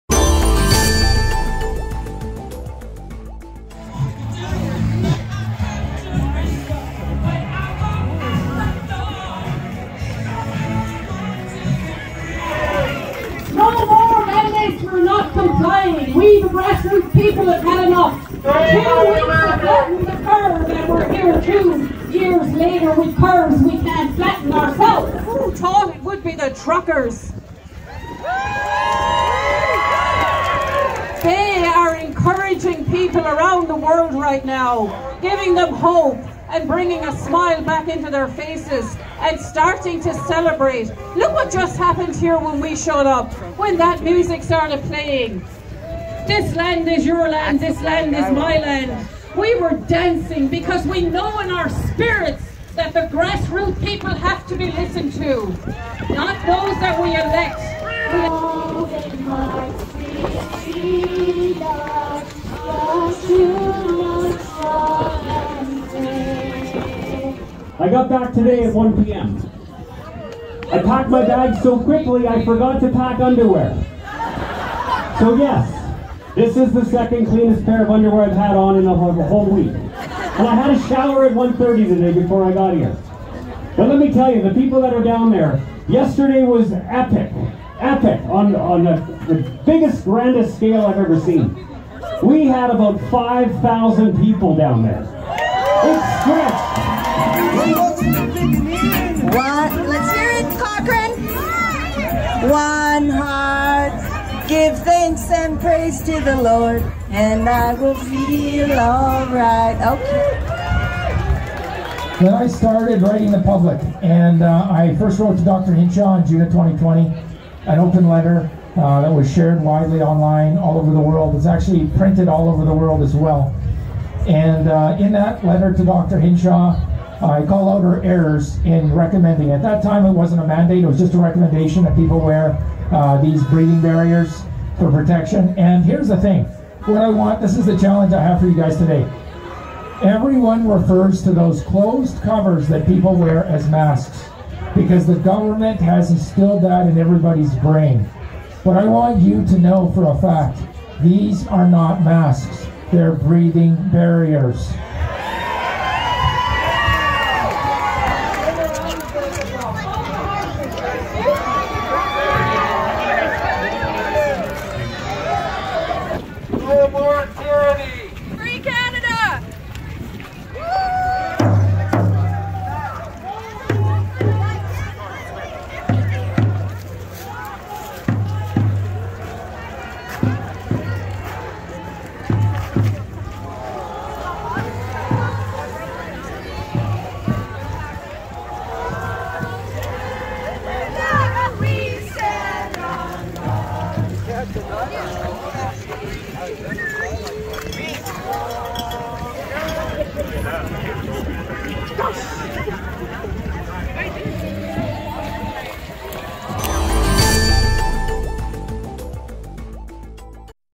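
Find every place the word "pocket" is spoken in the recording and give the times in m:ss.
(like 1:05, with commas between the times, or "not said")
not said.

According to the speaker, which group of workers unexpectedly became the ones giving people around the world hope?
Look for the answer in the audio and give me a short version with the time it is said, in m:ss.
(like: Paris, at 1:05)
truckers, at 0:26.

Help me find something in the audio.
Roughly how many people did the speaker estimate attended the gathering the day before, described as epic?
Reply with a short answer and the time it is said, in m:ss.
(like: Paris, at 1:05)
5,000, at 1:33.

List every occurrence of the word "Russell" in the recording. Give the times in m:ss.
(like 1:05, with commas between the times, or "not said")
not said.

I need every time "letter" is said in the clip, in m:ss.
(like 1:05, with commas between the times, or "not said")
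1:58, 2:05.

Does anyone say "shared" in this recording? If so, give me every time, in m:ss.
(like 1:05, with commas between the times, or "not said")
1:59.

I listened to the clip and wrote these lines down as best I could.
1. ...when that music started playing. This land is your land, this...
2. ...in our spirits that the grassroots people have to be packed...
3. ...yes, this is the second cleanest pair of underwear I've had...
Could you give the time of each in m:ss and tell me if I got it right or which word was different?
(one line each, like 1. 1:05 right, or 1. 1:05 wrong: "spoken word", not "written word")
1. 0:43 right
2. 0:51 wrong: "listened", not "packed"
3. 1:15 right.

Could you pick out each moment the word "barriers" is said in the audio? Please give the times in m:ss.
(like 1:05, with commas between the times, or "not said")
2:13, 2:33.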